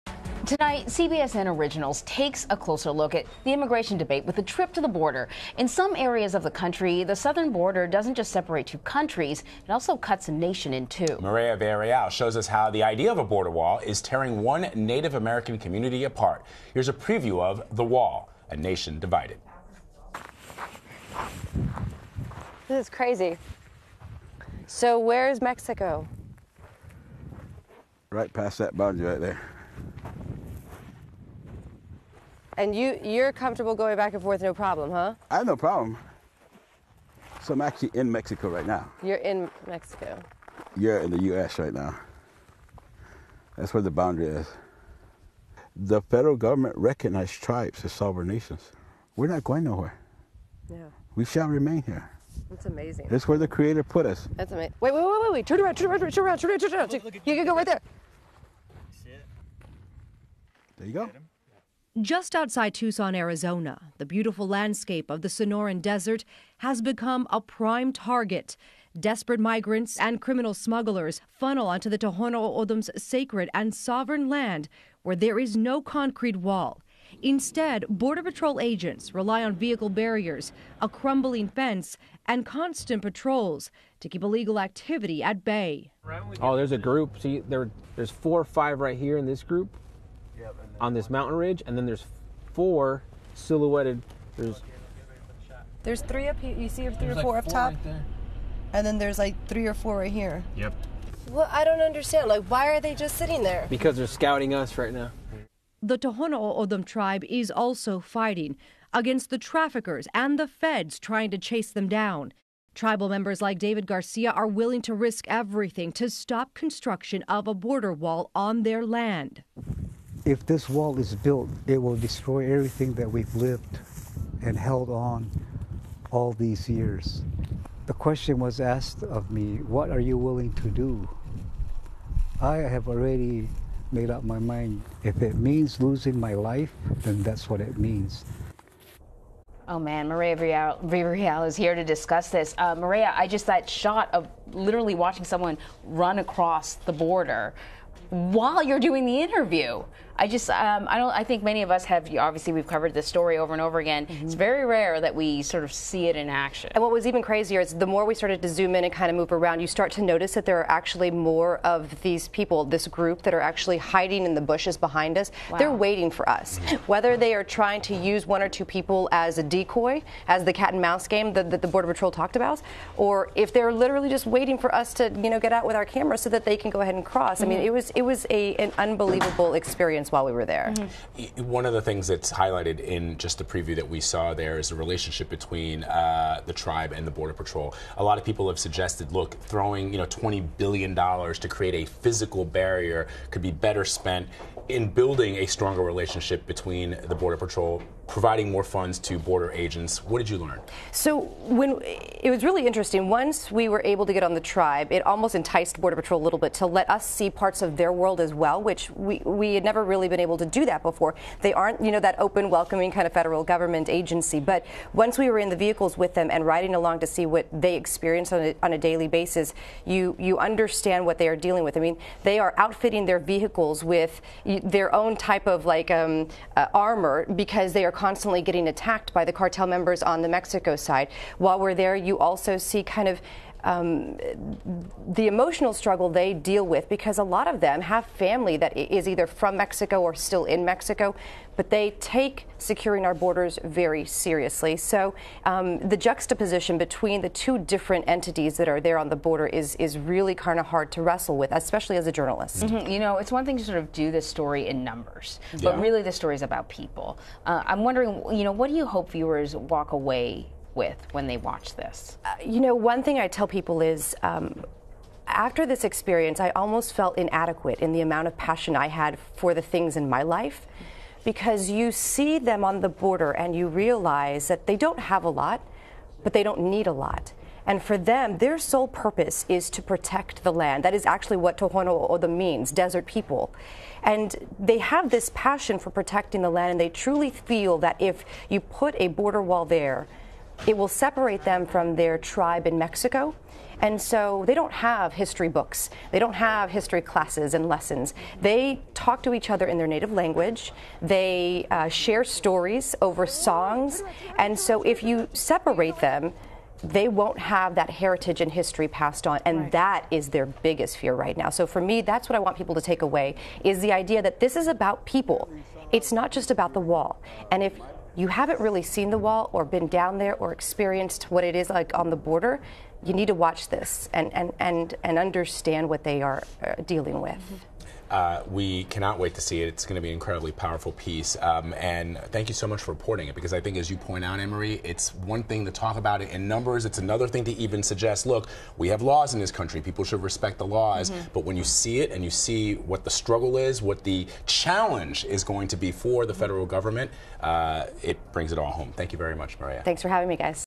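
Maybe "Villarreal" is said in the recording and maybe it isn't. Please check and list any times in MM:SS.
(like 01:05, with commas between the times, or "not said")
00:11, 02:20.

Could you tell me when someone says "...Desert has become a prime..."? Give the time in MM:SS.
01:05.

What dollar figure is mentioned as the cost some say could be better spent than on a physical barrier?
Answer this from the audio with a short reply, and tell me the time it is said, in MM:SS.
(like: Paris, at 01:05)
$20 billion, at 03:10.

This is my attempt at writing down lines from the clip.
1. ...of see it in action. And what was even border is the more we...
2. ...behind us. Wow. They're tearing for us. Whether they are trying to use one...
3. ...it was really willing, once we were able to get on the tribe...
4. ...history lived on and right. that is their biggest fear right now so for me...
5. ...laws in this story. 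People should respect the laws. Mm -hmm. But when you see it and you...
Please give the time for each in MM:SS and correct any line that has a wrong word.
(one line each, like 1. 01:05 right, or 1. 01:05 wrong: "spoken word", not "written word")
1. 02:35 wrong: "crazier", not "border"
2. 02:44 wrong: "waiting", not "tearing"
3. 03:22 wrong: "interesting", not "willing"
4. 05:08 wrong: "passed", not "lived"
5. 05:39 wrong: "country", not "story".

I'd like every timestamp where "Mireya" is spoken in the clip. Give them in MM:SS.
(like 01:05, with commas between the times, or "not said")
00:11, 02:20, 05:49.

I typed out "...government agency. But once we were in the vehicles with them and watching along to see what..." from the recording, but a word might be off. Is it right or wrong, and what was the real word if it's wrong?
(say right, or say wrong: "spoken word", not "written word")
wrong: "riding", not "watching".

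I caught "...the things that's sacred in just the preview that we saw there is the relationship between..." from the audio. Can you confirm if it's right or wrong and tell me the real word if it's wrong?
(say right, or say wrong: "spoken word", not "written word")
wrong: "highlighted", not "sacred".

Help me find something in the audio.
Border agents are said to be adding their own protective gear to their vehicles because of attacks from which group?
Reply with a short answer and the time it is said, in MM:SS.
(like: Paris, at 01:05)
cartel members, at 03:49.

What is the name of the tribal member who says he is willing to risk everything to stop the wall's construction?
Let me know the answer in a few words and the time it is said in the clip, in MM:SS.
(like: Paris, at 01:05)
David Garcia, at 01:53.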